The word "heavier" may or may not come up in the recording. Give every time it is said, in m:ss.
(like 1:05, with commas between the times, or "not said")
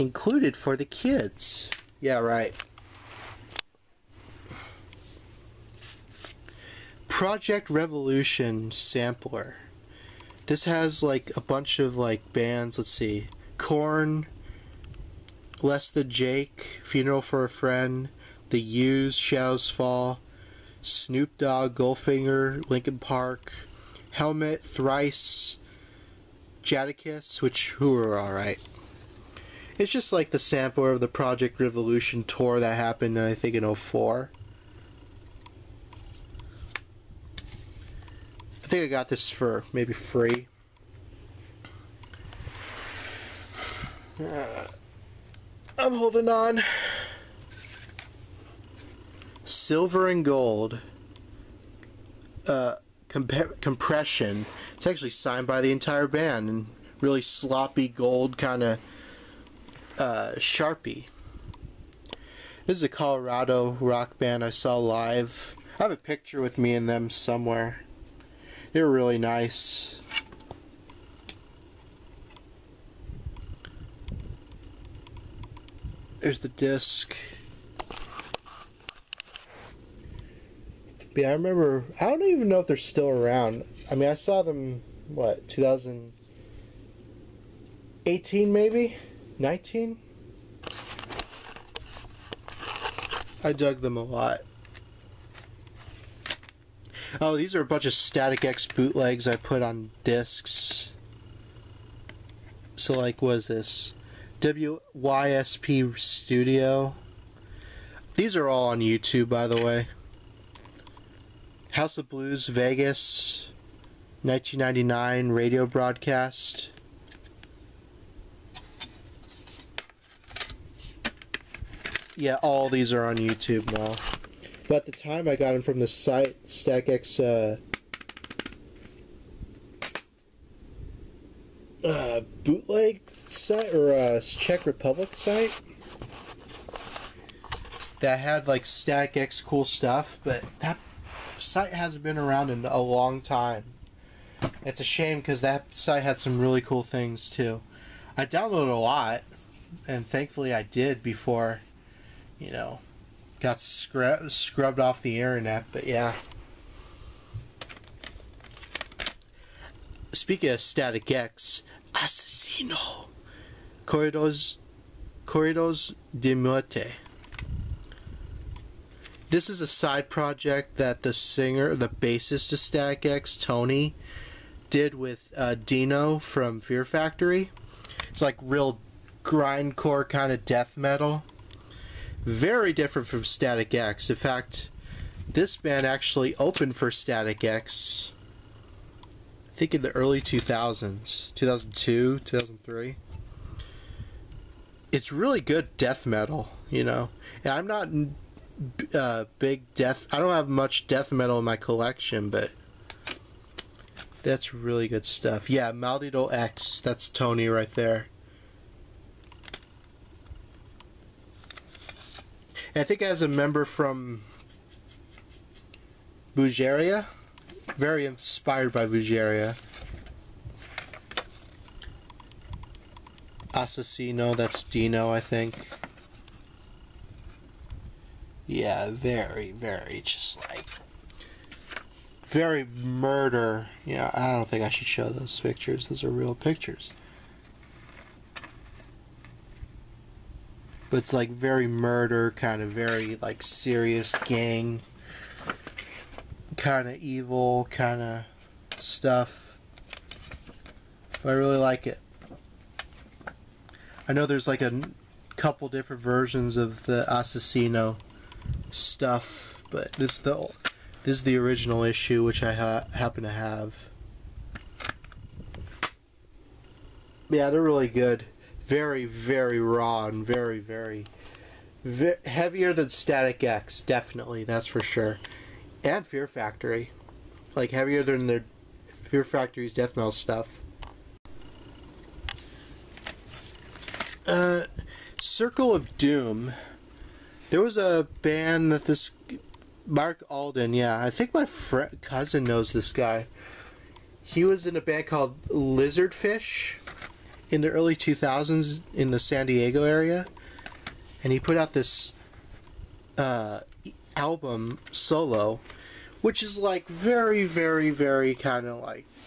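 4:32, 4:37.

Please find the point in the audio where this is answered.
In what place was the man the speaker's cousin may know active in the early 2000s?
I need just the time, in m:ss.
4:59.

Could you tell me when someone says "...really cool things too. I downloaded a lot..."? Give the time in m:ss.
2:26.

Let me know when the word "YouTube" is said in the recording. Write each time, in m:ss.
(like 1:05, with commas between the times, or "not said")
1:48, 2:03.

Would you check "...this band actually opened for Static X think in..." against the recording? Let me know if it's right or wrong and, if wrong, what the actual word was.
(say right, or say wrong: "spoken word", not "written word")
right.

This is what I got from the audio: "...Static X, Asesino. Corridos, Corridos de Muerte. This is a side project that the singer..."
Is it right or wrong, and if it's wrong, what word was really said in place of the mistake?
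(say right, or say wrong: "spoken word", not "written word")
right.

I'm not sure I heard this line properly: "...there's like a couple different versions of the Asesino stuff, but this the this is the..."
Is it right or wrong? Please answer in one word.
right.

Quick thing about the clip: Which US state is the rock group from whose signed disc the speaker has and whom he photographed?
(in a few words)
Colorado.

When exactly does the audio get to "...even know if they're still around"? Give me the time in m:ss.
1:22.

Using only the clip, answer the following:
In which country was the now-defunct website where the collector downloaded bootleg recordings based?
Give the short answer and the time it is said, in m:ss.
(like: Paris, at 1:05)
Czech Republic, at 2:14.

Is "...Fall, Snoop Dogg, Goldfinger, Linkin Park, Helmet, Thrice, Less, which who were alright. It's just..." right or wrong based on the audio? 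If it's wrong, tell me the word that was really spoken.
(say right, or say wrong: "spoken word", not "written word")
wrong: "Jadakiss", not "Less".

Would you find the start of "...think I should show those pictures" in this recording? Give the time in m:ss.
3:54.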